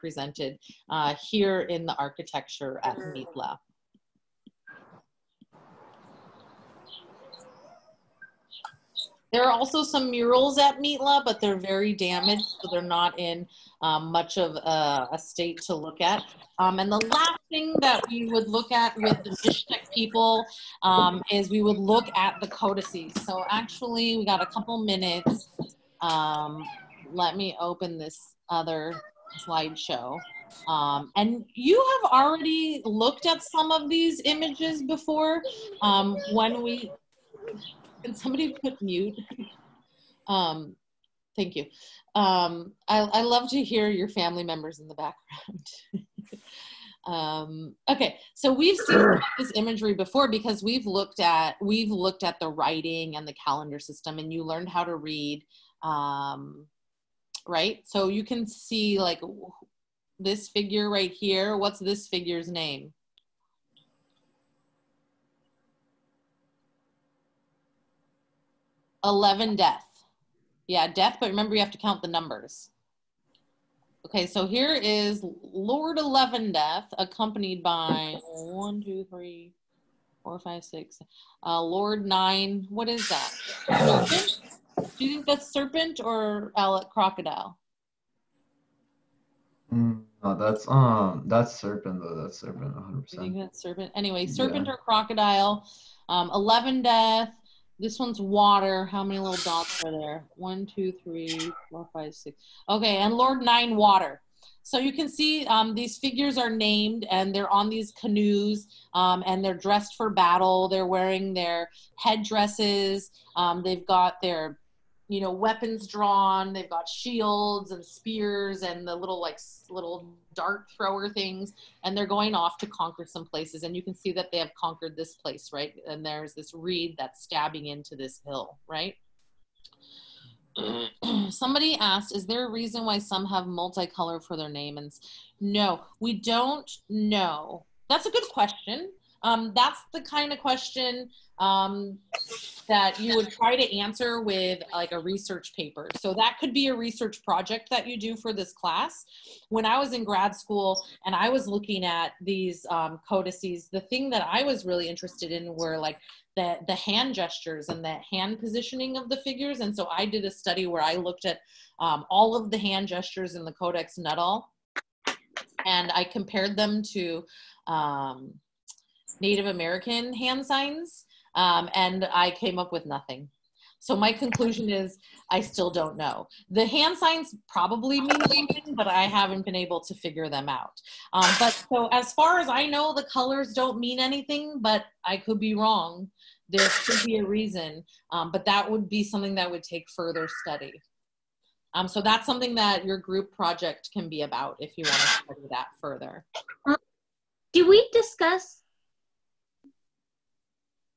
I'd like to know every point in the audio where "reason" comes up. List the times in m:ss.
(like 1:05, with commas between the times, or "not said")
2:12, 3:07.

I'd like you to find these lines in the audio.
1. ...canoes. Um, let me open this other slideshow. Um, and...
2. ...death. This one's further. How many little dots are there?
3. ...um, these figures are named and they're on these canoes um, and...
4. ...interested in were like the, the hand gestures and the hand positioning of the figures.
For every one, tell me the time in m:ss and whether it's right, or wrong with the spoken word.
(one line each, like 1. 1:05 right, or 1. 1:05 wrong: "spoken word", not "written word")
1. 0:24 wrong: "minutes", not "canoes"
2. 1:36 wrong: "water", not "further"
3. 1:45 right
4. 2:34 right.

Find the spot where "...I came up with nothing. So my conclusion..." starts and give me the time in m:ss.
2:52.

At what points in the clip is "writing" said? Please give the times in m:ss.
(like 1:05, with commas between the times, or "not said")
0:52.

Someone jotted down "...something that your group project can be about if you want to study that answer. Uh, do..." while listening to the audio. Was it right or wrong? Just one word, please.
wrong.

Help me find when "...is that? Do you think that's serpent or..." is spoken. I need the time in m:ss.
1:22.